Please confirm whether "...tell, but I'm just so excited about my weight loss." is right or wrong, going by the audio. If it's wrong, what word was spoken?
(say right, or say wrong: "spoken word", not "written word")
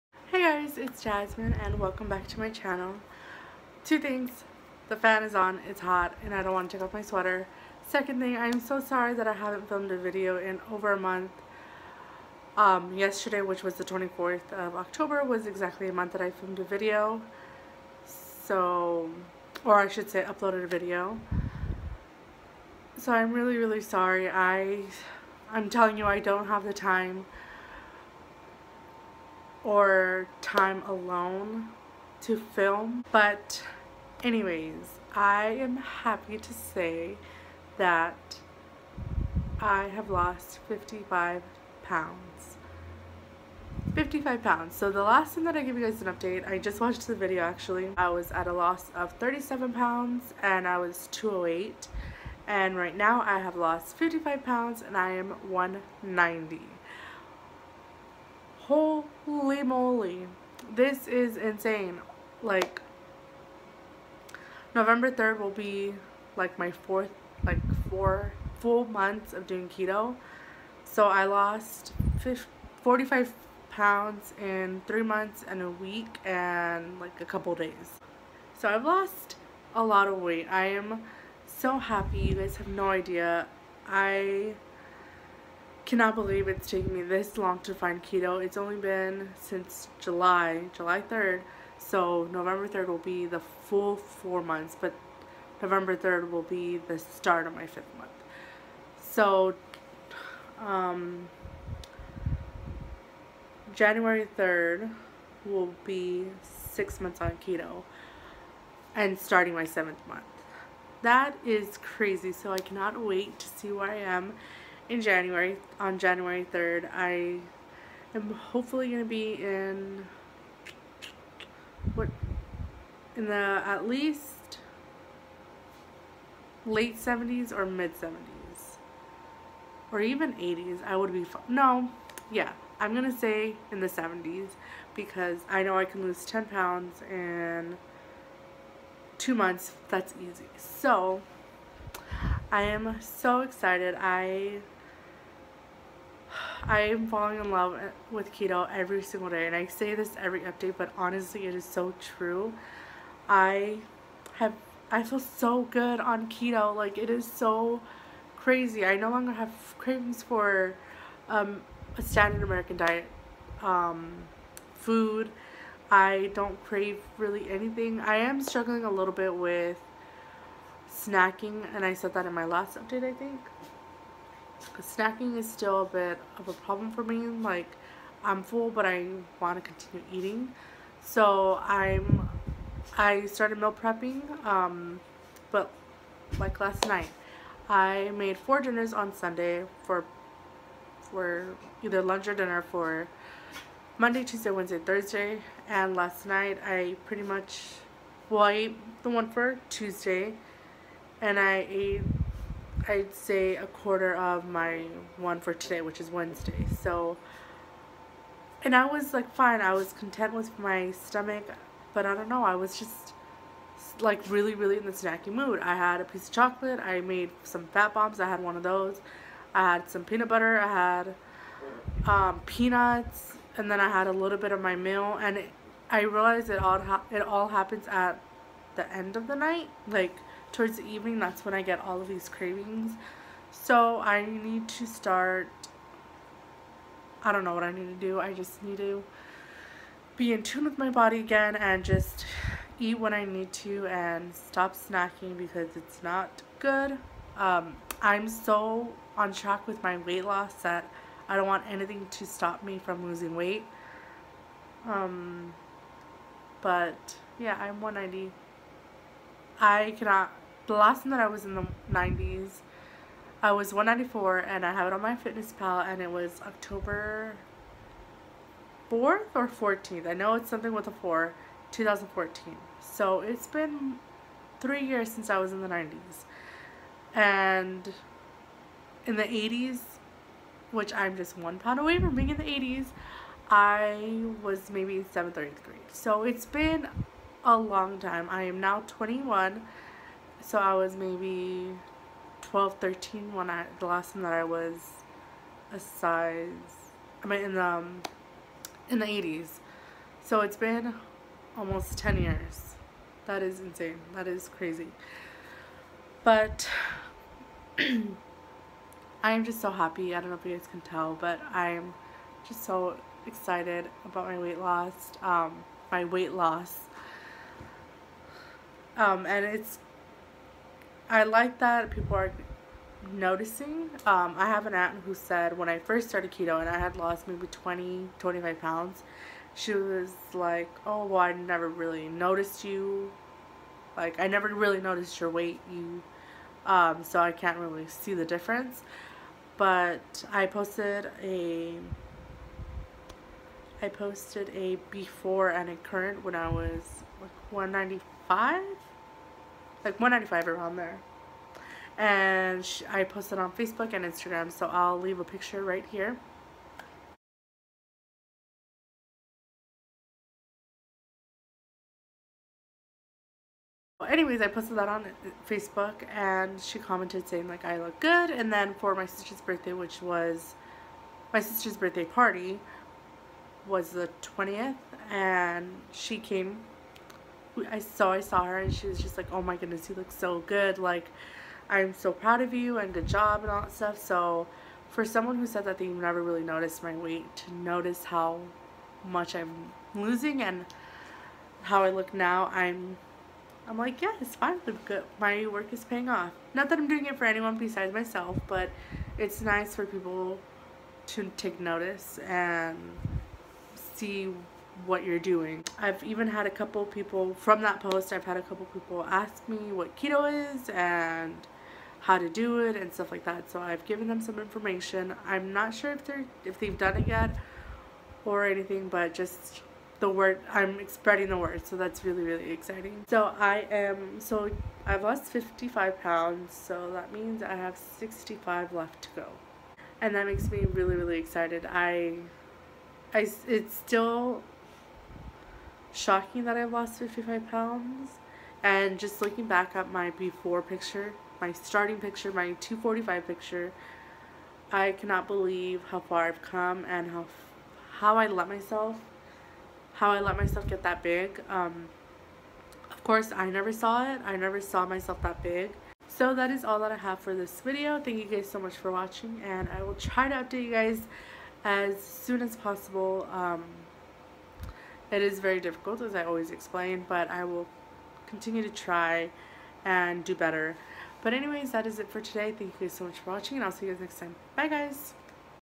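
right.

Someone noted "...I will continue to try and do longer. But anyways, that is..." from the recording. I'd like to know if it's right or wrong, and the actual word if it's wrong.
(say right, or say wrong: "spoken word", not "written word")
wrong: "better", not "longer".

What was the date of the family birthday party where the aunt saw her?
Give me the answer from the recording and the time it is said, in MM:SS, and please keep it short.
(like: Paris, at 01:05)
The 20th, at 06:13.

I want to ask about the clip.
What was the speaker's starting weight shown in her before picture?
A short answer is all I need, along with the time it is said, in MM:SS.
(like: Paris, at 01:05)
245, at 07:22.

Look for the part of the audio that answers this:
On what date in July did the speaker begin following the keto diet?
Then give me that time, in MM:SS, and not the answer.
01:30.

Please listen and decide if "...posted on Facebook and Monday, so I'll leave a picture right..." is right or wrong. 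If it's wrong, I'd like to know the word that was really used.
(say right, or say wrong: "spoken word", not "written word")
wrong: "Instagram", not "Monday".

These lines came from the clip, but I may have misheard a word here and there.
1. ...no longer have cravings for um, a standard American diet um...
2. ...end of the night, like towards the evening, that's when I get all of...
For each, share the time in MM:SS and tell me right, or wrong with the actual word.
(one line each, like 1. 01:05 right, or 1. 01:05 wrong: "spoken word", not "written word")
1. 02:38 right
2. 03:48 right.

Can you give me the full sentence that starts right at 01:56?
I am hopefully going to be in, what, in the at least late 70s or mid 70s.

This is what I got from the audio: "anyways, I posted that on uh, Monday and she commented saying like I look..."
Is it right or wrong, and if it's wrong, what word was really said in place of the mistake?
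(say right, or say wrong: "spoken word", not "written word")
wrong: "Facebook", not "Monday".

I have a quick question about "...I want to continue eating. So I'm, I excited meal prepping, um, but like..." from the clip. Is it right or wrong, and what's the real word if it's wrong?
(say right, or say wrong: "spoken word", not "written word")
wrong: "started", not "excited".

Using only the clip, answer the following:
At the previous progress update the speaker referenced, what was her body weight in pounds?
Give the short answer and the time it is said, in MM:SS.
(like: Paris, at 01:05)
208, at 00:51.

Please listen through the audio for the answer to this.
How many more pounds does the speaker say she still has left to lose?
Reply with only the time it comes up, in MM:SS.
07:07.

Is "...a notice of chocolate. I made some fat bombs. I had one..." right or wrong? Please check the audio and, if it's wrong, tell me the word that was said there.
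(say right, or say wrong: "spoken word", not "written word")
wrong: "piece", not "notice".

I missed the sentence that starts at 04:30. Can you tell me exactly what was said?
I know it's something with a 4, 2014.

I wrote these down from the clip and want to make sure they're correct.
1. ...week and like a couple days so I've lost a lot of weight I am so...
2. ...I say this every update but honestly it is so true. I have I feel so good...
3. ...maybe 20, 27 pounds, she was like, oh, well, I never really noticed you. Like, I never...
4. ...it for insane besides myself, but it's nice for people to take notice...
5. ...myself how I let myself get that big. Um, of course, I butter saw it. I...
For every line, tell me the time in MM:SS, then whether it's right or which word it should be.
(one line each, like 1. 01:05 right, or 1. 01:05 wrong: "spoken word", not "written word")
1. 01:15 right
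2. 02:29 right
3. 05:27 wrong: "25", not "27"
4. 06:37 wrong: "anyone", not "insane"
5. 07:28 wrong: "never", not "butter".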